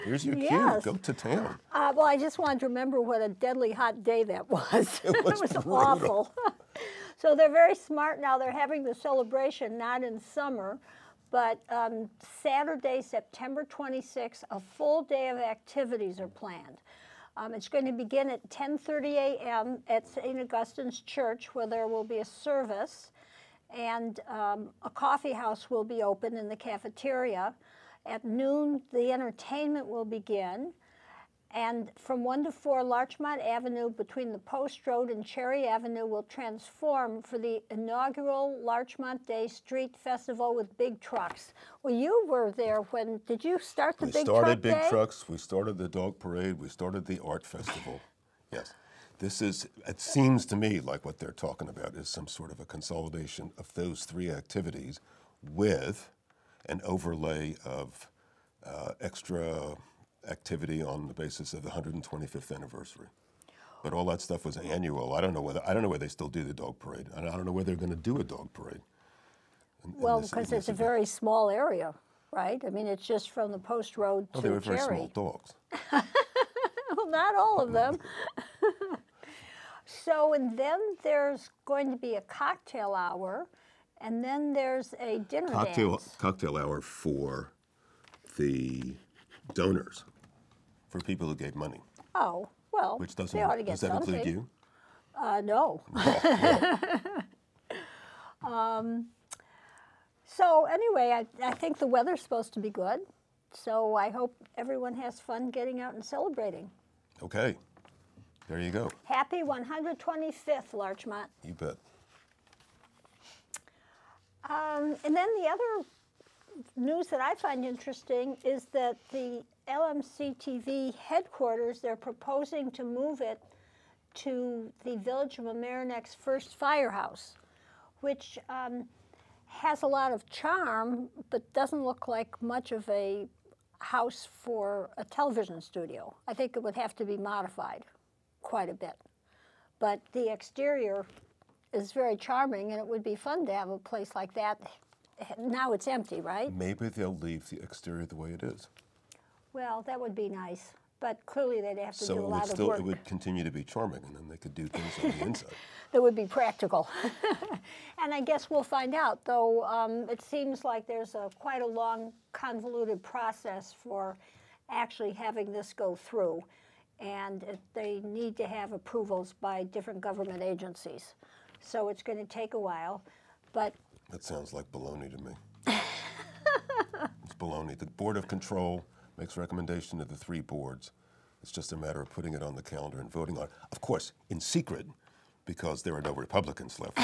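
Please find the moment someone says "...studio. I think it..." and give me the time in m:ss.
2:15.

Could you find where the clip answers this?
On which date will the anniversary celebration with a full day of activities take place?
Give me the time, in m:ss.
0:12.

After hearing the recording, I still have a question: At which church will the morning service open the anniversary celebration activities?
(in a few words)
St. Augustine's Church.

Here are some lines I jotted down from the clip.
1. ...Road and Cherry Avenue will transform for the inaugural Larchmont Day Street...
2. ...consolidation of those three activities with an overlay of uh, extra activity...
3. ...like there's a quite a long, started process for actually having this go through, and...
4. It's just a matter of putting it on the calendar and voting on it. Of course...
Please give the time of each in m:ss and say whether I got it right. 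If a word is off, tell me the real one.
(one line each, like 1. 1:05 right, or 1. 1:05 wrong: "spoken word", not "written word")
1. 0:34 right
2. 0:52 right
3. 2:40 wrong: "convoluted", not "started"
4. 3:01 right.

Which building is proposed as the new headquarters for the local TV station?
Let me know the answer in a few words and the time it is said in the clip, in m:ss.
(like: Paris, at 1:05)
Village of Mamaroneck's first firehouse, at 2:04.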